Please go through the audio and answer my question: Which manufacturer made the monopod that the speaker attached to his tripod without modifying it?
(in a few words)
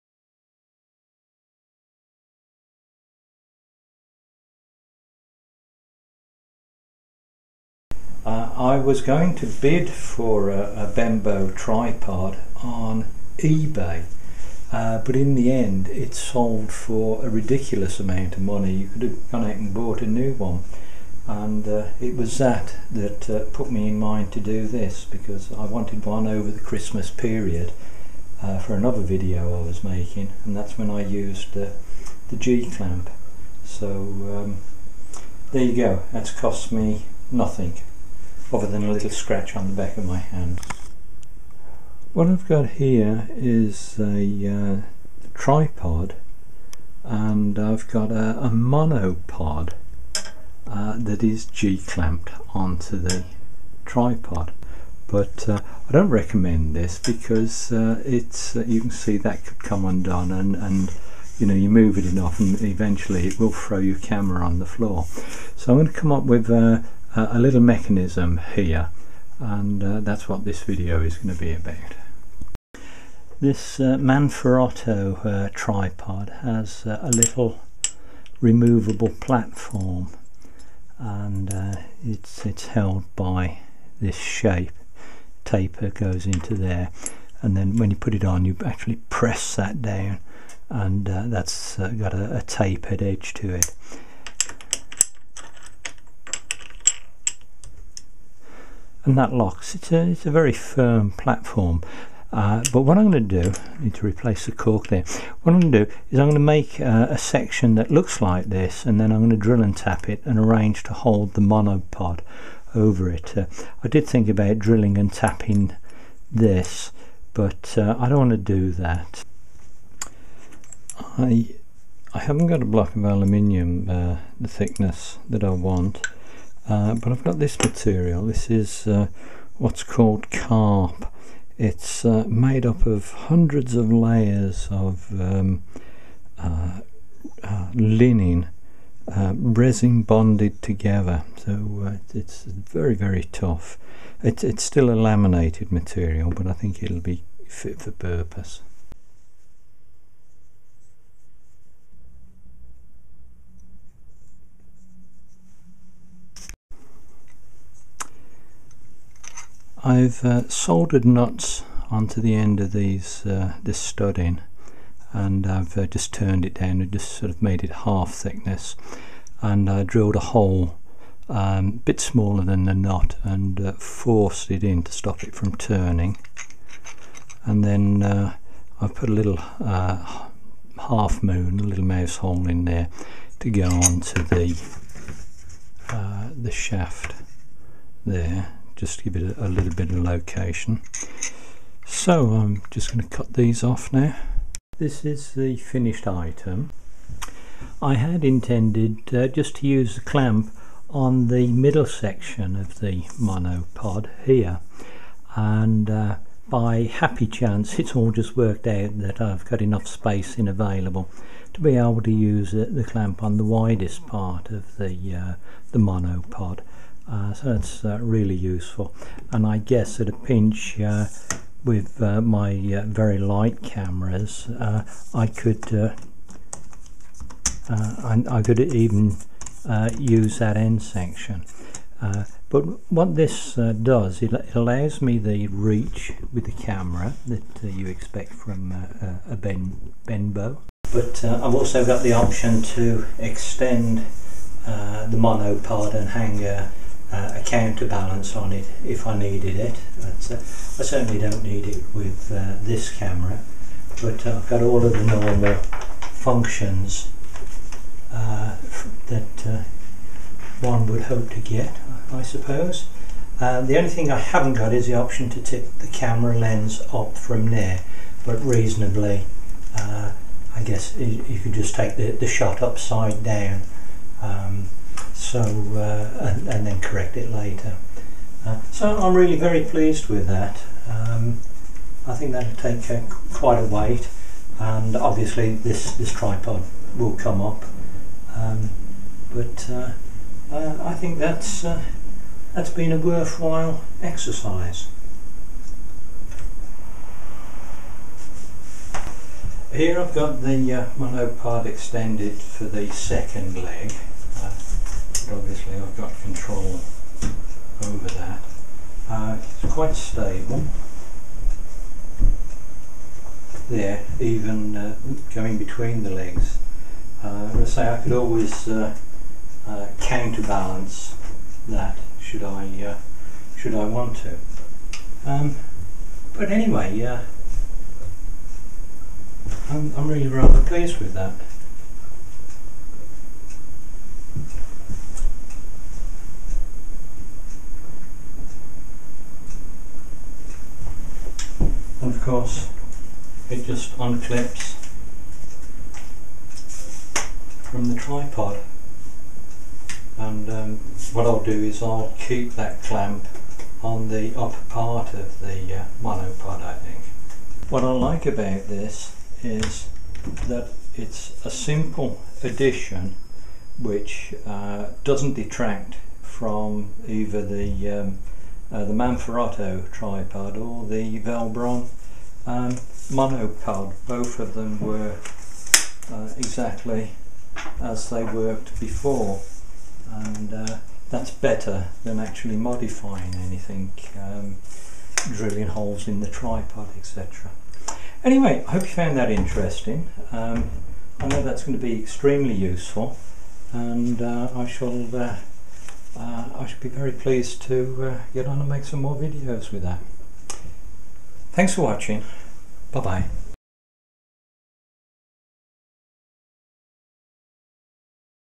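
Velbon.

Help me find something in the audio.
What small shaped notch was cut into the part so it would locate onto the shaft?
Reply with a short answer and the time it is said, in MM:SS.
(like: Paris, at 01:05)
mouse hole, at 03:01.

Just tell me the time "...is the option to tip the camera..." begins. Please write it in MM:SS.
04:24.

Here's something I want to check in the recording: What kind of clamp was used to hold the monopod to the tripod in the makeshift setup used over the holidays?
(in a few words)
G clamp.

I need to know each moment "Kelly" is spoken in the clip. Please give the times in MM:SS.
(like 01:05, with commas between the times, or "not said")
not said.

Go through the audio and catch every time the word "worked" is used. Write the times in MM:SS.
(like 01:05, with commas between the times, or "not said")
03:28, 06:18.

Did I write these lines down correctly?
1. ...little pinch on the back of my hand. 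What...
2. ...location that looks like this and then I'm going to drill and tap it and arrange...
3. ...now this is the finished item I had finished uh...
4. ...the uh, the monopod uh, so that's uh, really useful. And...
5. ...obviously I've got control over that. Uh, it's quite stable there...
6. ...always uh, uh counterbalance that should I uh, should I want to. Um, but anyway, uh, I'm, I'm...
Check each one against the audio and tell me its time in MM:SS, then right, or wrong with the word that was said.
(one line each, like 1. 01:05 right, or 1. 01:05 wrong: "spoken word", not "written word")
1. 00:38 wrong: "scratch", not "pinch"
2. 01:47 wrong: "section", not "location"
3. 03:13 wrong: "intended", not "finished"
4. 03:34 right
5. 05:05 right
6. 05:18 right.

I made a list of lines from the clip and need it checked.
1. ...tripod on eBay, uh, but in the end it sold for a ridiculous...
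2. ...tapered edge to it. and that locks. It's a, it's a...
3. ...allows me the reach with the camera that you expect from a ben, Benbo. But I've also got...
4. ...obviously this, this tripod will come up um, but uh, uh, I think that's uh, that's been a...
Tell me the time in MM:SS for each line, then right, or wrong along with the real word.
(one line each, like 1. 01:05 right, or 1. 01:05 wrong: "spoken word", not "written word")
1. 00:11 right
2. 01:32 right
3. 03:54 right
4. 04:44 right.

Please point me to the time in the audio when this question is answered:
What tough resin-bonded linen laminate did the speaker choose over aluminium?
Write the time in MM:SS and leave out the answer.
02:10.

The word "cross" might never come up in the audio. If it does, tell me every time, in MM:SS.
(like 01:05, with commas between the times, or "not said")
not said.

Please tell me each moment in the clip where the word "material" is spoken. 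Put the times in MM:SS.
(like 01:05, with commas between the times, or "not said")
02:07, 02:25.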